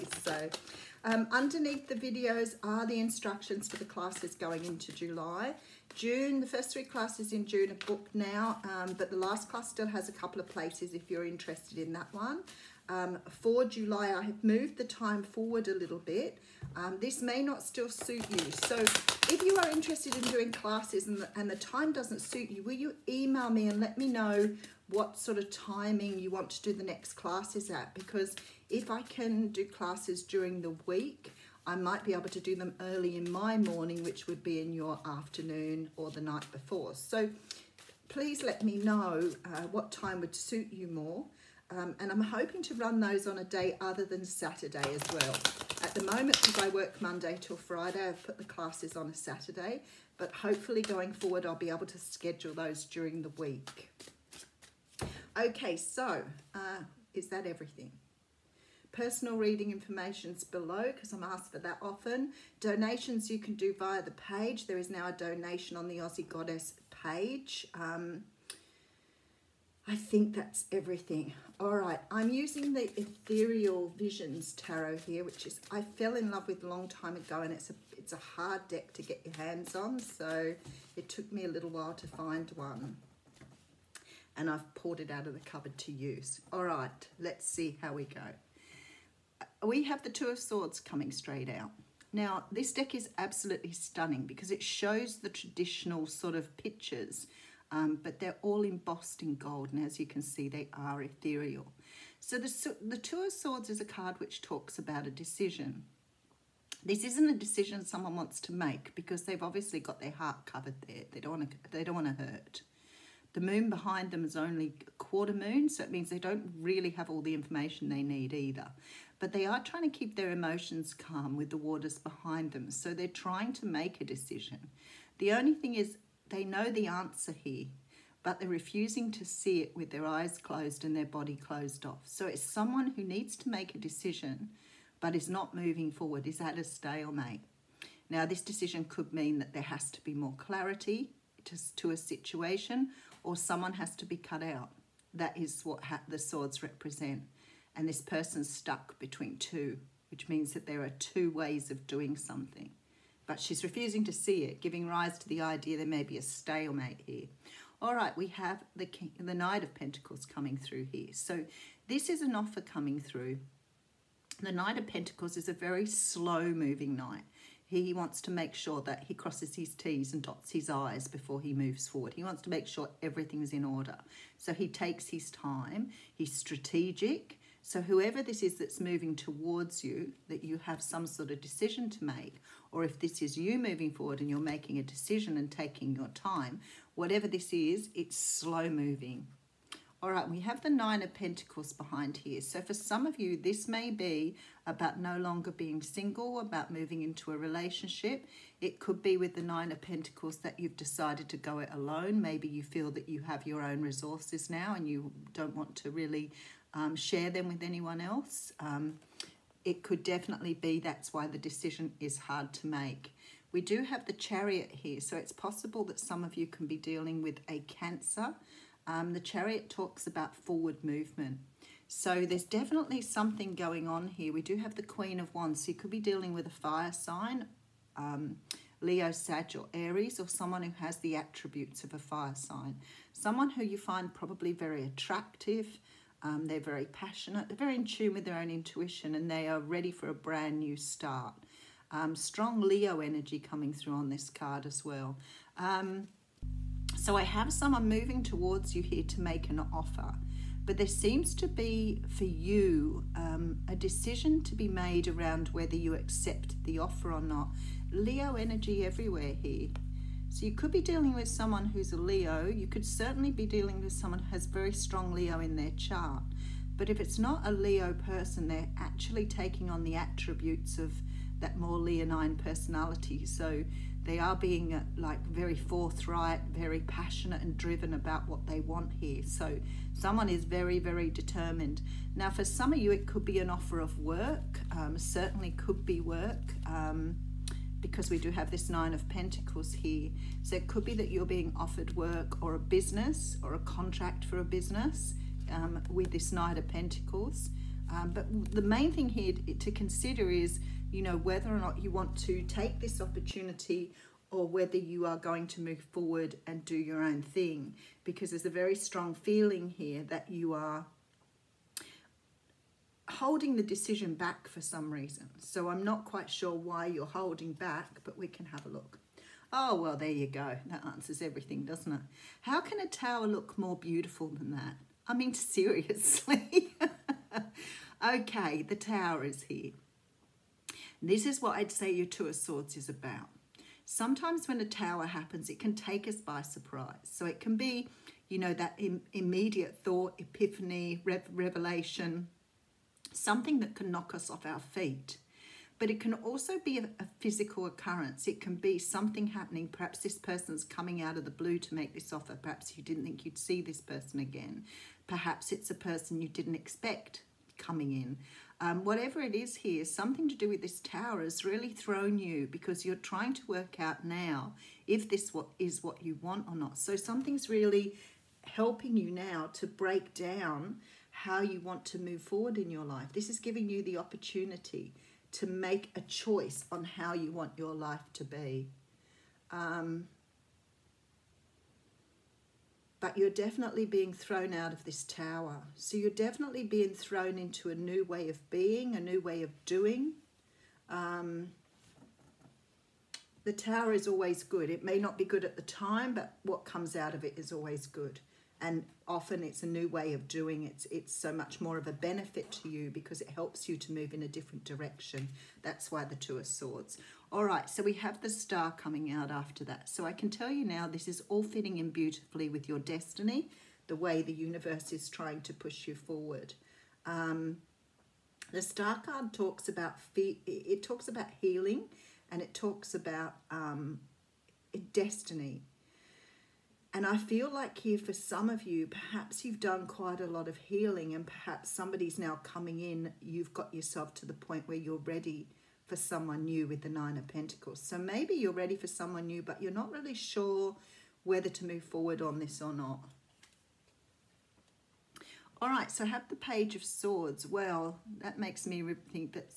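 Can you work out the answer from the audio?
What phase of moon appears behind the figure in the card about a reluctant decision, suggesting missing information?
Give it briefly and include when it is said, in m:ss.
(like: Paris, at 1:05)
Quarter moon, at 1:54.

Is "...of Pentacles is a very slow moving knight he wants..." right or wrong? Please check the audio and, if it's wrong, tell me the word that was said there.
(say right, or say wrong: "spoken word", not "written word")
right.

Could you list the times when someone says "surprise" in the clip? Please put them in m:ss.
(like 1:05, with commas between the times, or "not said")
5:36.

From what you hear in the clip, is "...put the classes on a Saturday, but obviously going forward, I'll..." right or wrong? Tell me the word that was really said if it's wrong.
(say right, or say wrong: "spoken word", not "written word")
wrong: "hopefully", not "obviously".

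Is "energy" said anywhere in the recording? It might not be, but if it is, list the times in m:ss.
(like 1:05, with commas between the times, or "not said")
4:03, 4:18.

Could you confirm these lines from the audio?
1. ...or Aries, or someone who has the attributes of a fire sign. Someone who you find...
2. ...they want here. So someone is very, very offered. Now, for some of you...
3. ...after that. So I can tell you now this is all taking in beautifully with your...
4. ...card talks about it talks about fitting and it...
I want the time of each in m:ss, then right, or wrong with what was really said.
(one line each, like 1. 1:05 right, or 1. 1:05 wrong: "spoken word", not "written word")
1. 3:49 right
2. 4:38 wrong: "determined", not "offered"
3. 6:49 wrong: "fitting", not "taking"
4. 6:59 wrong: "healing", not "fitting".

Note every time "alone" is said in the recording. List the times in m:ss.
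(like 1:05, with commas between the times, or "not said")
3:21.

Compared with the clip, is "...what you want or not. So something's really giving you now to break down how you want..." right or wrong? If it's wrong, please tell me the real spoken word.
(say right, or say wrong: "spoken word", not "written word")
wrong: "helping", not "giving".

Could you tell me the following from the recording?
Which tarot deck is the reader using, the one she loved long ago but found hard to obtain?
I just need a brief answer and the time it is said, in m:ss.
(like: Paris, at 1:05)
Ethereal Visions Tarot, at 1:13.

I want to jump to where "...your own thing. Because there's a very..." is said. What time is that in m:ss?
5:06.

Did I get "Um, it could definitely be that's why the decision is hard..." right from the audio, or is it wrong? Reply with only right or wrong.
right.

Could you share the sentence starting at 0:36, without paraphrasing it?
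So please let me know uh, what time would suit you more.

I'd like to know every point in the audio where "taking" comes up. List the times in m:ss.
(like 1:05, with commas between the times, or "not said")
3:05, 4:29.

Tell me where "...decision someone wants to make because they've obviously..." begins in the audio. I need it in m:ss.
1:47.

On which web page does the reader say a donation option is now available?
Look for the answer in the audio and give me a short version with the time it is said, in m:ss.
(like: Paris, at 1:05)
Aussie Goddess page, at 1:05.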